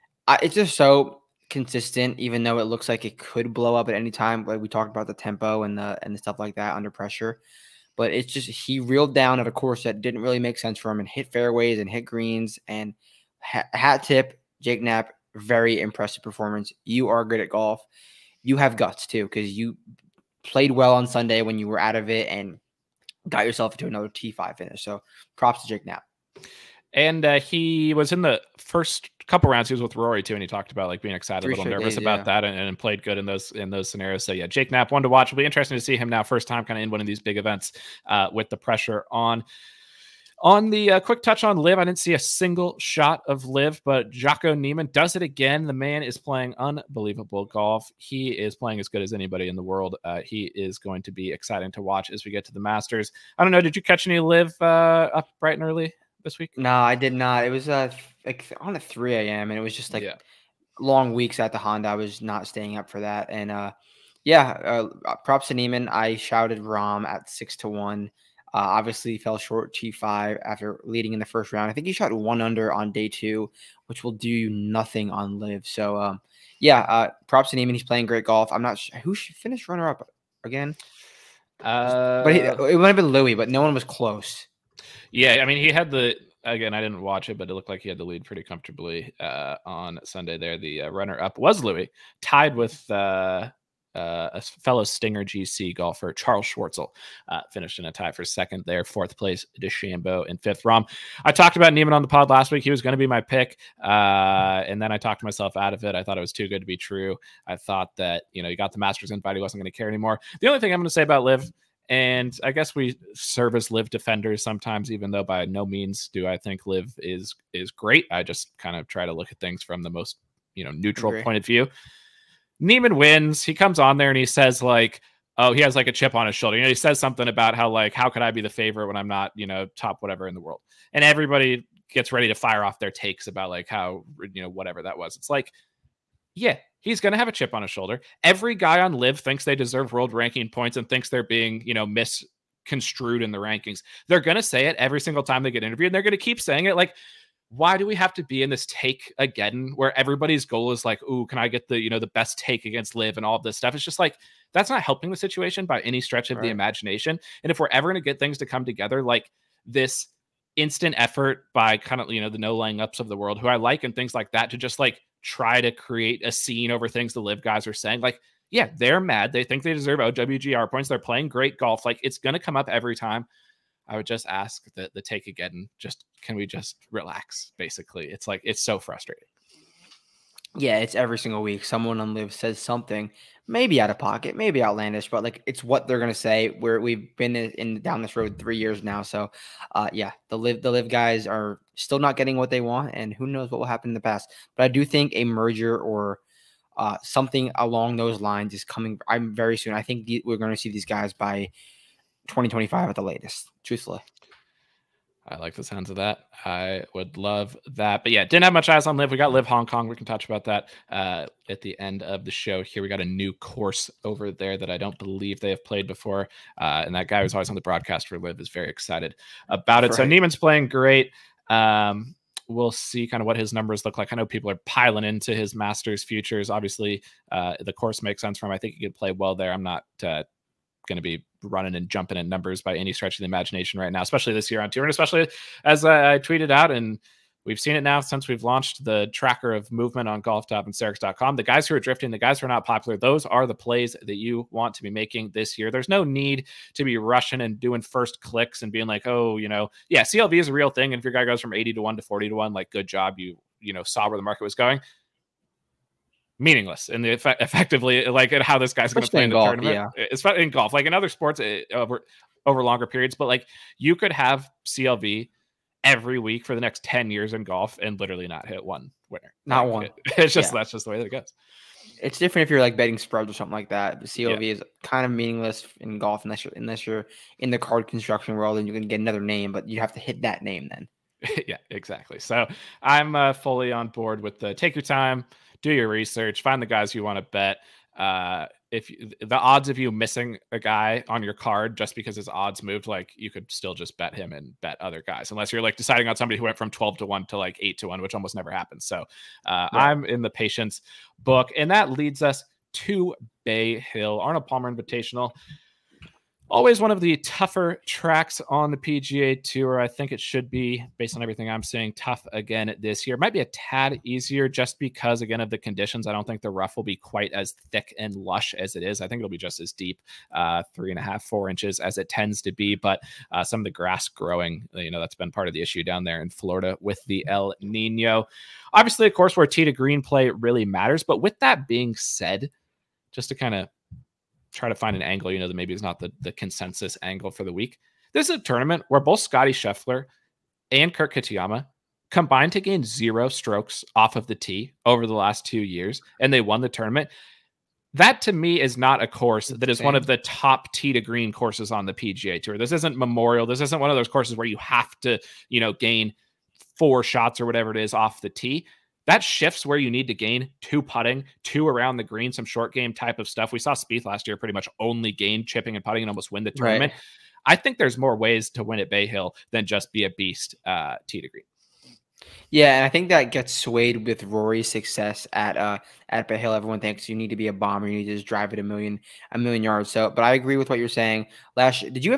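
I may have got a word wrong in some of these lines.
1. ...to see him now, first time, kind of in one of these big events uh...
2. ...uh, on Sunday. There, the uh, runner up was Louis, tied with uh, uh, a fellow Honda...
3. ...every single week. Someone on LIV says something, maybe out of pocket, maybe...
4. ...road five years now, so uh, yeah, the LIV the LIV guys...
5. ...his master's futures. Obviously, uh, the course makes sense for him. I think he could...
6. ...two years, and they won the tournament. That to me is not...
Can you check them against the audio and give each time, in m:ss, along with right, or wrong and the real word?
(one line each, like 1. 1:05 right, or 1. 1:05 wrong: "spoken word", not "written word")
1. 0:35 right
2. 1:29 wrong: "Stinger", not "Honda"
3. 3:00 right
4. 3:08 wrong: "three", not "five"
5. 3:45 right
6. 5:45 right.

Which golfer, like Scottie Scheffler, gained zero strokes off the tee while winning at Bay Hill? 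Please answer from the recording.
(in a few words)
Kurt Kitayama.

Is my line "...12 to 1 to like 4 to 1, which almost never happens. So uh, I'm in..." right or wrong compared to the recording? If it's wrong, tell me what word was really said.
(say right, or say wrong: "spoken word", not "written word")
wrong: "8", not "4".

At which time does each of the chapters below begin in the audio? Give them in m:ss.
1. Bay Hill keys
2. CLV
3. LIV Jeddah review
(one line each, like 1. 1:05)
1. 5:05
2. 3:35
3. 0:45.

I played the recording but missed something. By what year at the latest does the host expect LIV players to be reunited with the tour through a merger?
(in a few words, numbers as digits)
2025.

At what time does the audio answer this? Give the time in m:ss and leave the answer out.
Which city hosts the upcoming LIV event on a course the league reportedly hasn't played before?
3:29.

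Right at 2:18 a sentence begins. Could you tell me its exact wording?
Every guy on LIV thinks they deserve world ranking points and thinks they're being you know misconstrued in the rankings.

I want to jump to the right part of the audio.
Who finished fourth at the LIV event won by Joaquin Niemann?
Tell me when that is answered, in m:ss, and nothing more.
1:39.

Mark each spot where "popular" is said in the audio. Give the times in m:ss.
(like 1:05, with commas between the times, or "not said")
4:02.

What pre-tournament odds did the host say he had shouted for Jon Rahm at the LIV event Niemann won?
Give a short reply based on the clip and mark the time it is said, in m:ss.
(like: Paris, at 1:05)
6 to 1, at 1:07.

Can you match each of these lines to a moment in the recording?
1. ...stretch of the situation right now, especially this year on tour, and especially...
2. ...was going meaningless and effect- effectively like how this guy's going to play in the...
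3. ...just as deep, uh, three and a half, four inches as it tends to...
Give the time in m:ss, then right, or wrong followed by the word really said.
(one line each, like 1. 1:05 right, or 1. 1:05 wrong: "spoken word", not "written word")
1. 3:52 wrong: "imagination", not "situation"
2. 4:14 right
3. 5:19 right.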